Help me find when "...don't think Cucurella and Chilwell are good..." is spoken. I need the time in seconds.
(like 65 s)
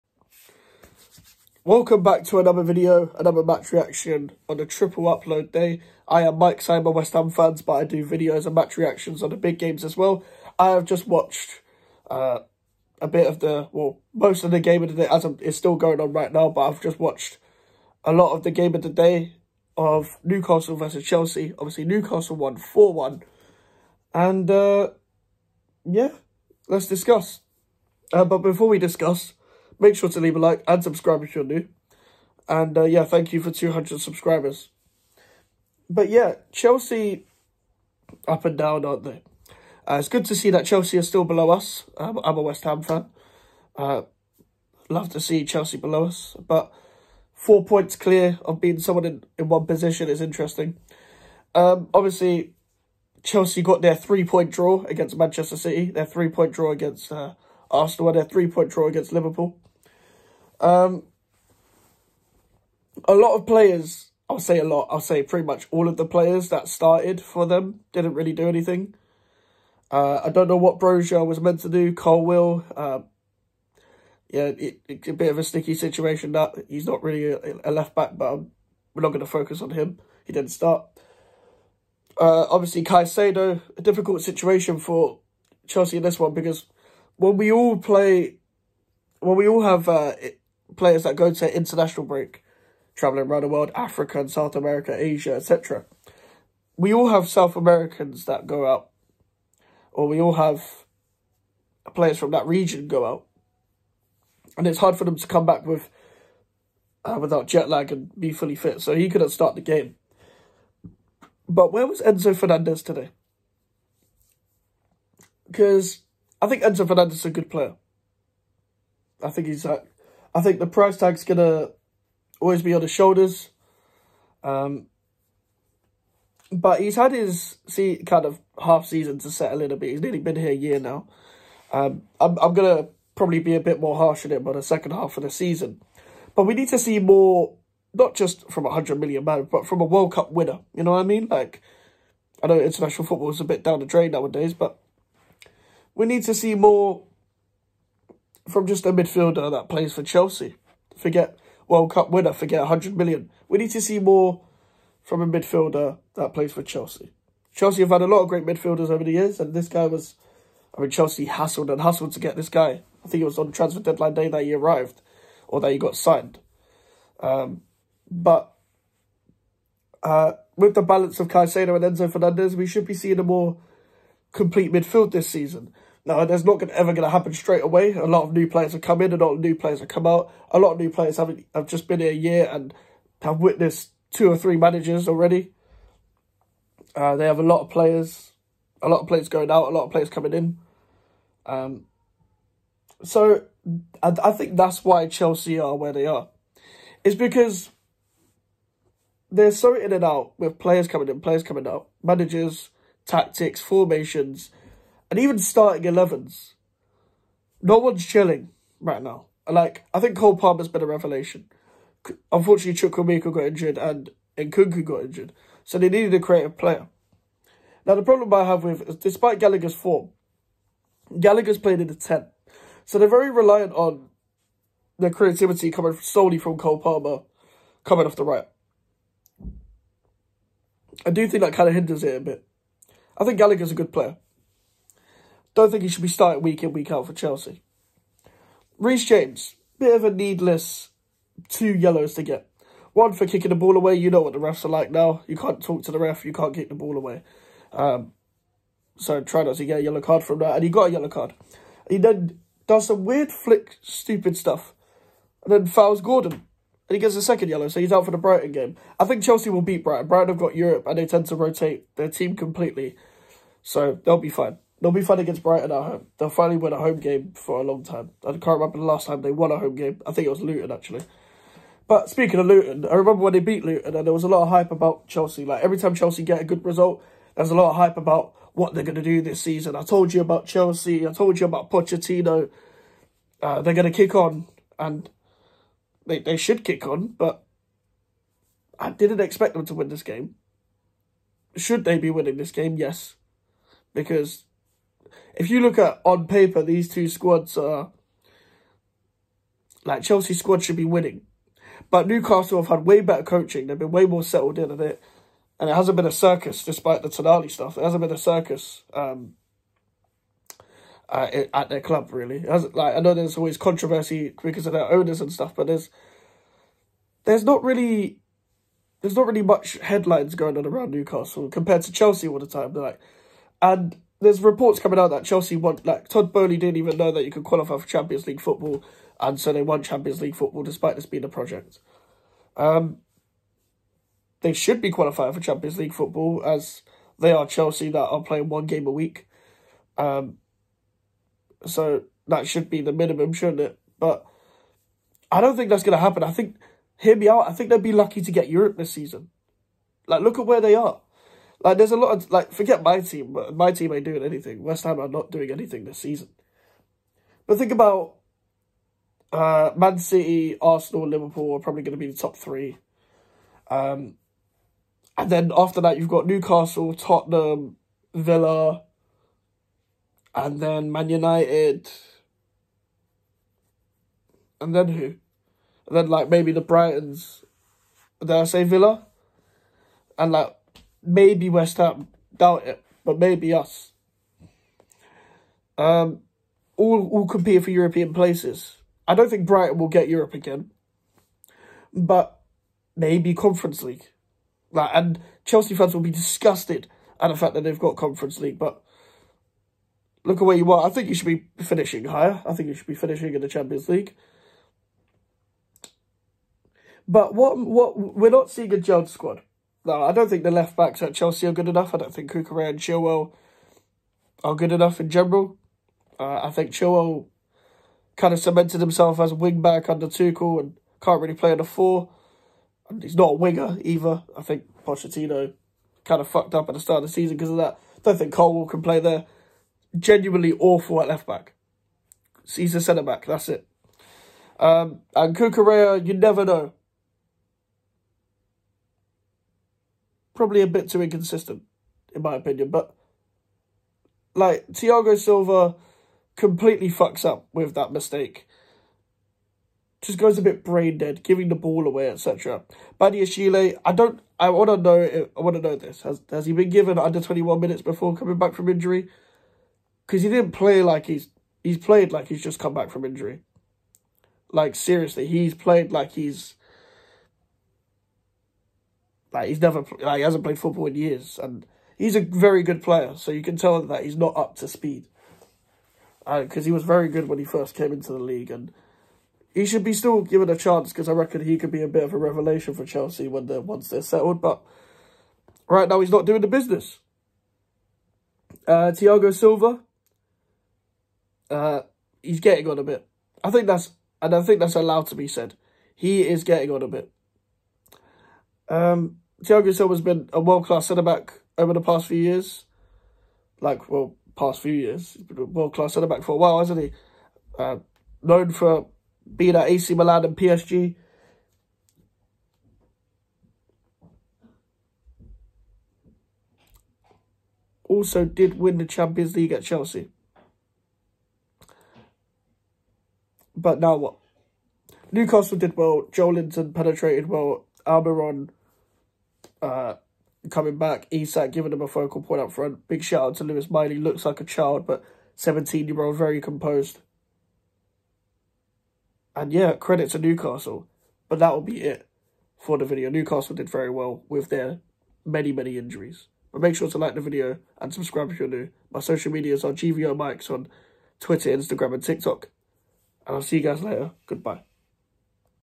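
411 s.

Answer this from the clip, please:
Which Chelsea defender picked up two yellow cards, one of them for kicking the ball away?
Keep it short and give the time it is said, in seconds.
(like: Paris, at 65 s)
Reece James, at 238 s.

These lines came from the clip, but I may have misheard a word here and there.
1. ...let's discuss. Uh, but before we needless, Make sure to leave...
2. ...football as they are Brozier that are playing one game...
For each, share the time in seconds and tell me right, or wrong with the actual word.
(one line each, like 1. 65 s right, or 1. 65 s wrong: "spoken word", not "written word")
1. 26 s wrong: "discuss", not "needless"
2. 335 s wrong: "Chelsea", not "Brozier".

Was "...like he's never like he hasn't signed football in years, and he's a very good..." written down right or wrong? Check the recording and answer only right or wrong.
wrong.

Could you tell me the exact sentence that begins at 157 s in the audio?
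Chelsea have had a lot of great midfielders over the years, and this guy was...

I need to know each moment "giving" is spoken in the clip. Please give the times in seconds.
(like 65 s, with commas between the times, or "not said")
451 s, 531 s.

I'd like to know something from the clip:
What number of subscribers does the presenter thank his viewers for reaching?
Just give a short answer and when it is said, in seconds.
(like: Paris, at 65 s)
200, at 33 s.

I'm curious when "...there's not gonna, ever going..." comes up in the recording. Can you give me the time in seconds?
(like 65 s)
176 s.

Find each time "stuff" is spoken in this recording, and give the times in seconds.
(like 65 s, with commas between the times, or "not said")
254 s, 307 s, 315 s.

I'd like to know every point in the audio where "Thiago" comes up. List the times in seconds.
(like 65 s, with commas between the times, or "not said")
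444 s, 488 s, 499 s.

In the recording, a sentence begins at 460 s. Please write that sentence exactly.
Because he didn't play like he's, he's played like he's just come back from injury.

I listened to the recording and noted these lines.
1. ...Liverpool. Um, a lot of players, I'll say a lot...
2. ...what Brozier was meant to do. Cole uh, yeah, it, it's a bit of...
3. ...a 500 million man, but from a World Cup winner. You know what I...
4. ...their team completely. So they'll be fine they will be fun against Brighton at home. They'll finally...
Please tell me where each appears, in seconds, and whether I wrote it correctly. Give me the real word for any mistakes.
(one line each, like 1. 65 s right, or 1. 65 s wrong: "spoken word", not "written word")
1. 59 s right
2. 70 s right
3. 138 s wrong: "100", not "500"
4. 261 s right.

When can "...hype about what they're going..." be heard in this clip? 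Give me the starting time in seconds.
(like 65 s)
277 s.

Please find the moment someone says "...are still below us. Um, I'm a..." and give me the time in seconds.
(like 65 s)
40 s.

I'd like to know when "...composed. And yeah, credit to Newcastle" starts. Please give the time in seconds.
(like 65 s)
536 s.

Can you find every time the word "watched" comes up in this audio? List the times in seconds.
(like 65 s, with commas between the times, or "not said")
11 s, 16 s.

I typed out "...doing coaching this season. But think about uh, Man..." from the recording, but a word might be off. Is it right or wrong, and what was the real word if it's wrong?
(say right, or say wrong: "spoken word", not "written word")
wrong: "anything", not "coaching".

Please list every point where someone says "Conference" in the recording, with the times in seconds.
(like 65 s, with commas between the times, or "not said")
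393 s, 397 s.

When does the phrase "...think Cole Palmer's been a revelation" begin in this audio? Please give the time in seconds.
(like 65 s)
209 s.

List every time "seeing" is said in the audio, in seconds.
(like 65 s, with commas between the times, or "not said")
172 s, 408 s.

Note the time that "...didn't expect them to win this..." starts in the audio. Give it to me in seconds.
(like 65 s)
288 s.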